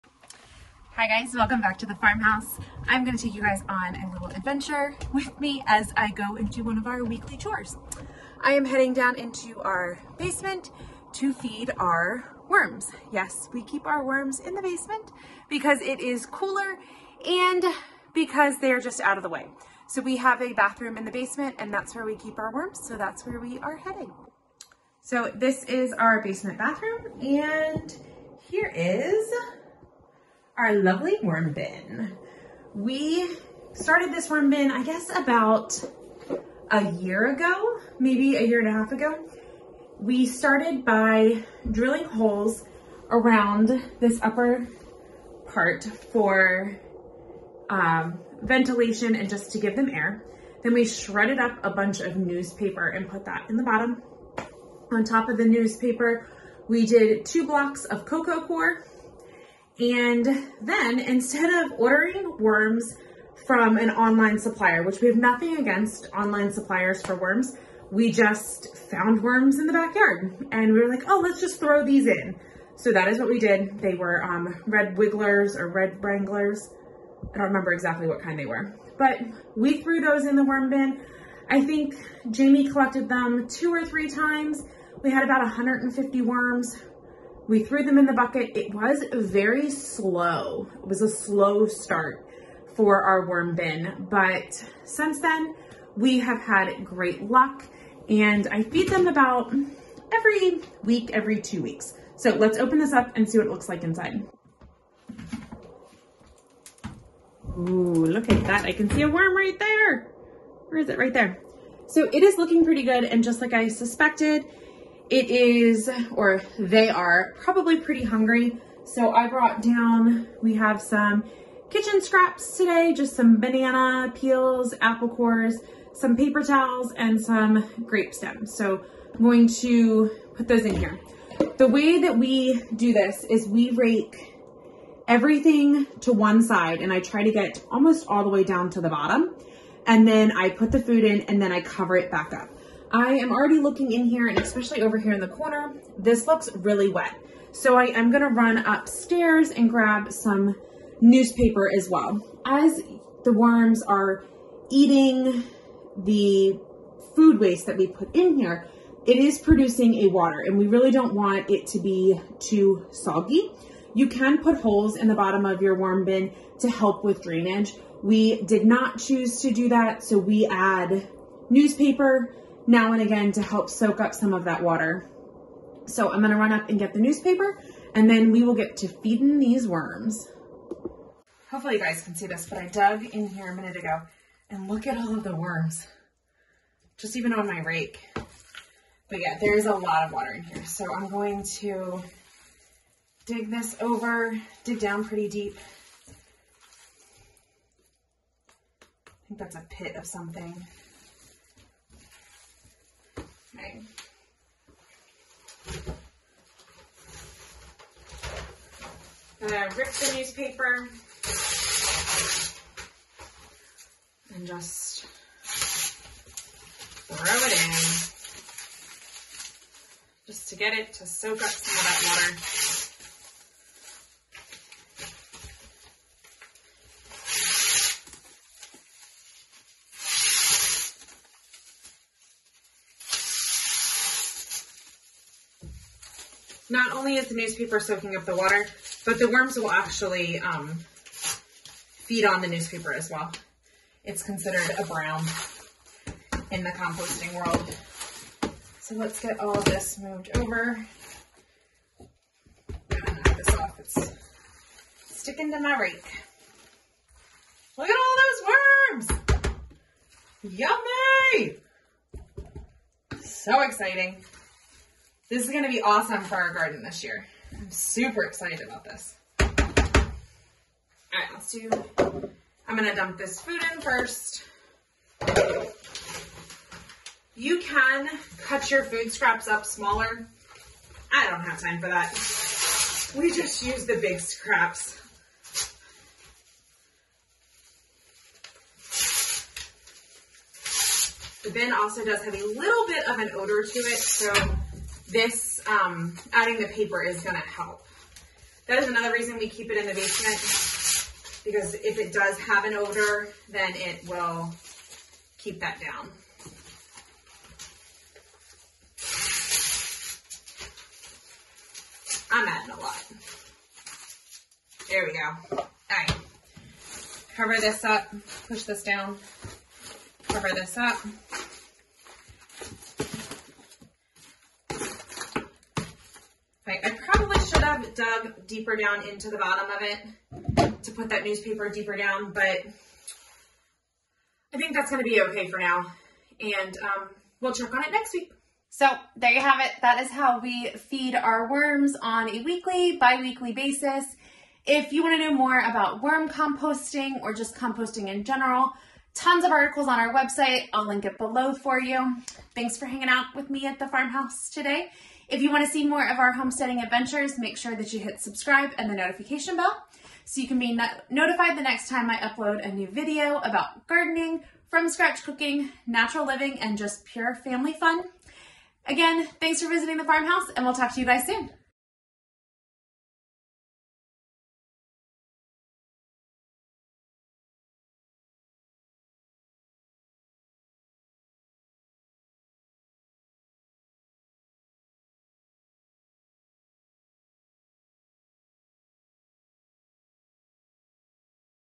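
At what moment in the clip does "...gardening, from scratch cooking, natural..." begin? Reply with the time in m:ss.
6:03.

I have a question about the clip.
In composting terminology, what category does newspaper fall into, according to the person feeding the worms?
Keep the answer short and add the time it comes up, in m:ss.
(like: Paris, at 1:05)
A brown, at 4:04.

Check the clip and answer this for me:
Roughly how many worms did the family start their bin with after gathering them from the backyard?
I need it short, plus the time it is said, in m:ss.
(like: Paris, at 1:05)
About 150, at 1:25.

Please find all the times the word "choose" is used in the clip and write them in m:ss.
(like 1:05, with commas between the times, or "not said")
2:48.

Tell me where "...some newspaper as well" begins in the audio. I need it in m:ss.
2:30.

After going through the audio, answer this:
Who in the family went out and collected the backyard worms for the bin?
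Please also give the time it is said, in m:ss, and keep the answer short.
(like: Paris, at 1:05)
Jamie, at 1:22.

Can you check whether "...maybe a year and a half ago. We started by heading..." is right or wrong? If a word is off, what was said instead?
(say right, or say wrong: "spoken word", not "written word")
wrong: "drilling", not "heading".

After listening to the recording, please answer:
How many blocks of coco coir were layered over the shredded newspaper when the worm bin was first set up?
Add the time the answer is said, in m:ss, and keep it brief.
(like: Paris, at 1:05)
2, at 0:57.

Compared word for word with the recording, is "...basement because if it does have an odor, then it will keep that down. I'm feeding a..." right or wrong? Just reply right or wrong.
wrong.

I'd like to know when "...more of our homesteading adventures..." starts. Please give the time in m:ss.
5:55.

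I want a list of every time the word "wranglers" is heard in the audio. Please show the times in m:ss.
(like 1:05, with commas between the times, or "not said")
1:16.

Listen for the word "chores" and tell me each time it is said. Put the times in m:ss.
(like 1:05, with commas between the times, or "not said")
0:07.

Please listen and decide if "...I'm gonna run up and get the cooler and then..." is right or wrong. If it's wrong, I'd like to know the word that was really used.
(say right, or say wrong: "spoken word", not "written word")
wrong: "newspaper", not "cooler".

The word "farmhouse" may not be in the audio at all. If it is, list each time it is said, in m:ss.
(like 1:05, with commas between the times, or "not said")
0:01, 5:53, 6:10.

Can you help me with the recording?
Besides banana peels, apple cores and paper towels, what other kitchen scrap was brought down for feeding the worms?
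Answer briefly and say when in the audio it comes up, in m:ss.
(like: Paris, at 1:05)
Grape stems, at 2:07.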